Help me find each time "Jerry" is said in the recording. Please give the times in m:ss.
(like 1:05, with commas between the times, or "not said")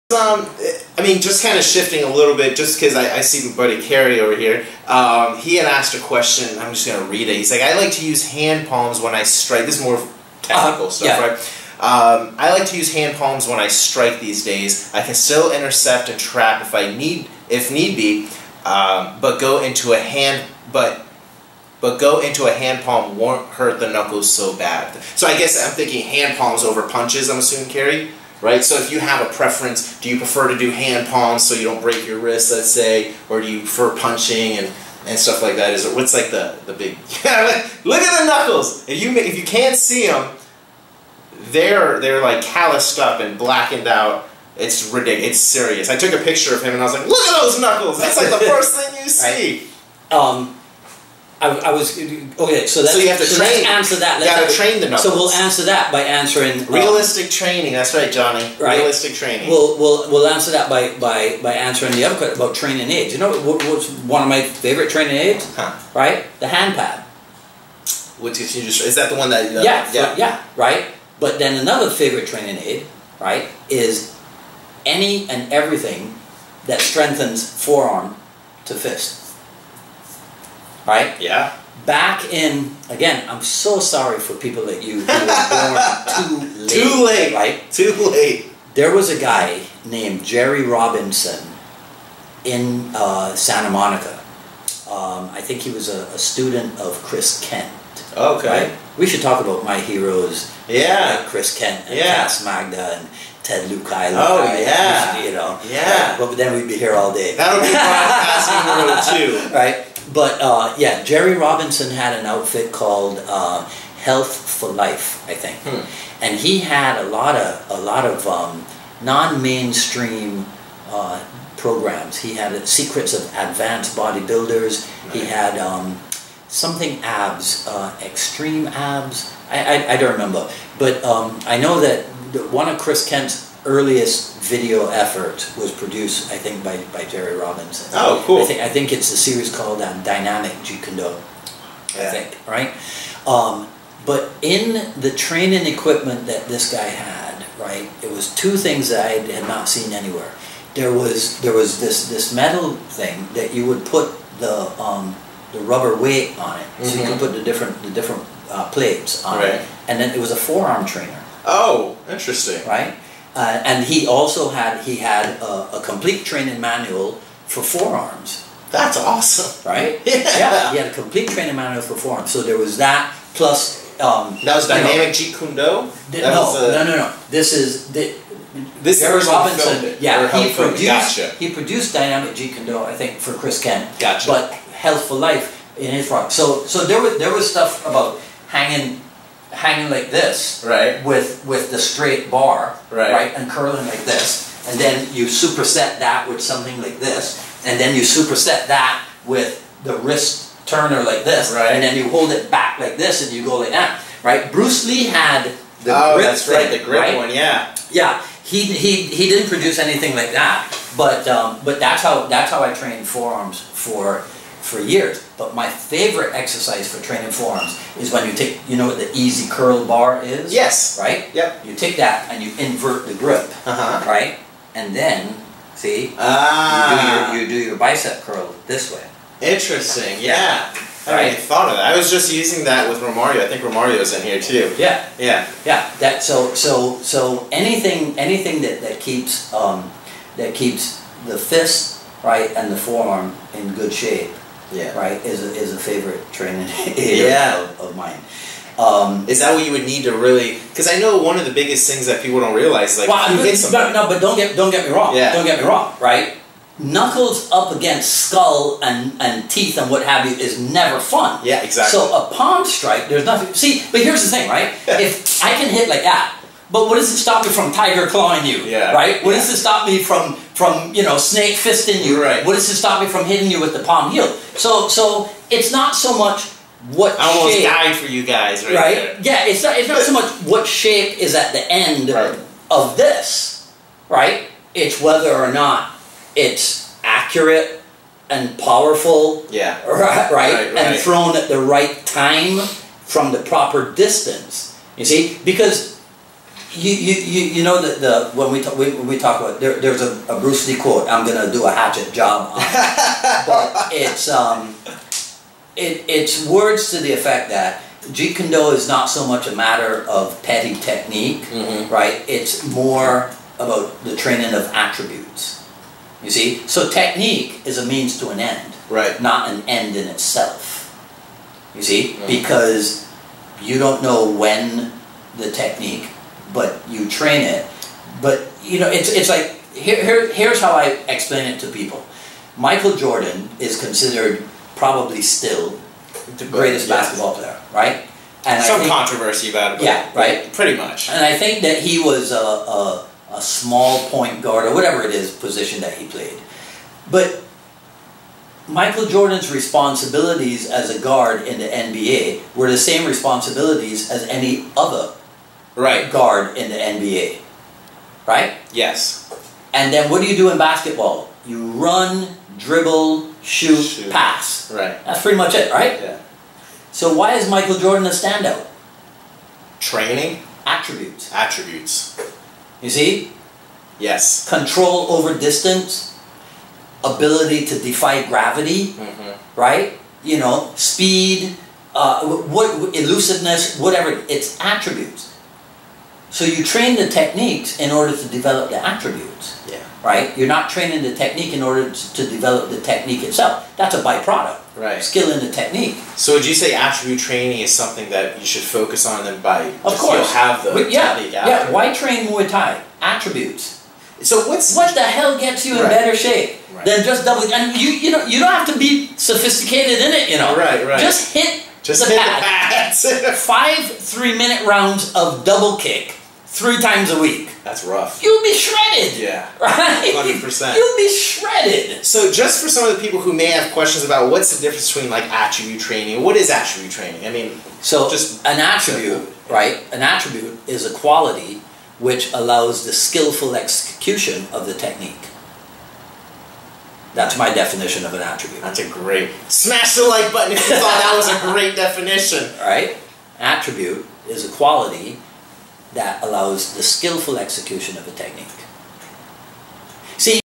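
1:30, 1:51, 2:17.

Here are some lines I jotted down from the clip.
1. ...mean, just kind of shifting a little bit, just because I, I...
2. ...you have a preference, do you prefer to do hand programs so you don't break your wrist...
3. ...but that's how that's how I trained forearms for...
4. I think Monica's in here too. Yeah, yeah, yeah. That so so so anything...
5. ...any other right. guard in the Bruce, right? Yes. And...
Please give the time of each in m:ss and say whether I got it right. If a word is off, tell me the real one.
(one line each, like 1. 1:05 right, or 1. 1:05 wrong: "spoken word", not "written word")
1. 0:01 right
2. 0:28 wrong: "palms", not "programs"
3. 3:31 right
4. 3:53 wrong: "Romario", not "Monica"
5. 5:54 wrong: "NBA", not "Bruce".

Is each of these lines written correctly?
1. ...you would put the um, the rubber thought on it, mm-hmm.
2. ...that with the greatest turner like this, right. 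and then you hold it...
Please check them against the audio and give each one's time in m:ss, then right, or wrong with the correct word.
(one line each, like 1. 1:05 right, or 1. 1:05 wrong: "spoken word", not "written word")
1. 2:33 wrong: "weight", not "thought"
2. 3:18 wrong: "wrist", not "greatest".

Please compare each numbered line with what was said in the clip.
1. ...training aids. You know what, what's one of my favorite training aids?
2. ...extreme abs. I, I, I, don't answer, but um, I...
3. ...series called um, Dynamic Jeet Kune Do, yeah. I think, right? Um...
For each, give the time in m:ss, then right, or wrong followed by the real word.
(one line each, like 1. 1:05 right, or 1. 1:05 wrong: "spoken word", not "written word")
1. 1:02 right
2. 2:08 wrong: "remember", not "answer"
3. 2:19 right.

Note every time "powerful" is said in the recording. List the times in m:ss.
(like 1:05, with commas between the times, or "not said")
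4:48.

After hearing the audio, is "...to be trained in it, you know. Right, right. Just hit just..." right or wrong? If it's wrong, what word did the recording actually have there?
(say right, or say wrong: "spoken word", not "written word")
wrong: "sophisticated", not "trained".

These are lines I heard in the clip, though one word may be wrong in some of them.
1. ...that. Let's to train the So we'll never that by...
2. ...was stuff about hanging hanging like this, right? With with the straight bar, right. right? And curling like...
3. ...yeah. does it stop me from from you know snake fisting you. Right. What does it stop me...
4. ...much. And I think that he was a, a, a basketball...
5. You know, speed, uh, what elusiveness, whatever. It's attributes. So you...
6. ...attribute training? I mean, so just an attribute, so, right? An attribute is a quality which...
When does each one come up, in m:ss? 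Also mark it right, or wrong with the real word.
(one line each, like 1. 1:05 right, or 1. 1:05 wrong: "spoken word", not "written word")
1. 0:53 wrong: "answer", not "never"
2. 3:07 right
3. 4:29 right
4. 5:40 wrong: "small", not "basketball"
5. 6:20 right
6. 7:06 right.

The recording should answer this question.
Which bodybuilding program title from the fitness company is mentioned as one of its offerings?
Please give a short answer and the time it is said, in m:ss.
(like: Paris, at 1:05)
Secrets of Advanced Bodybuilders, at 2:02.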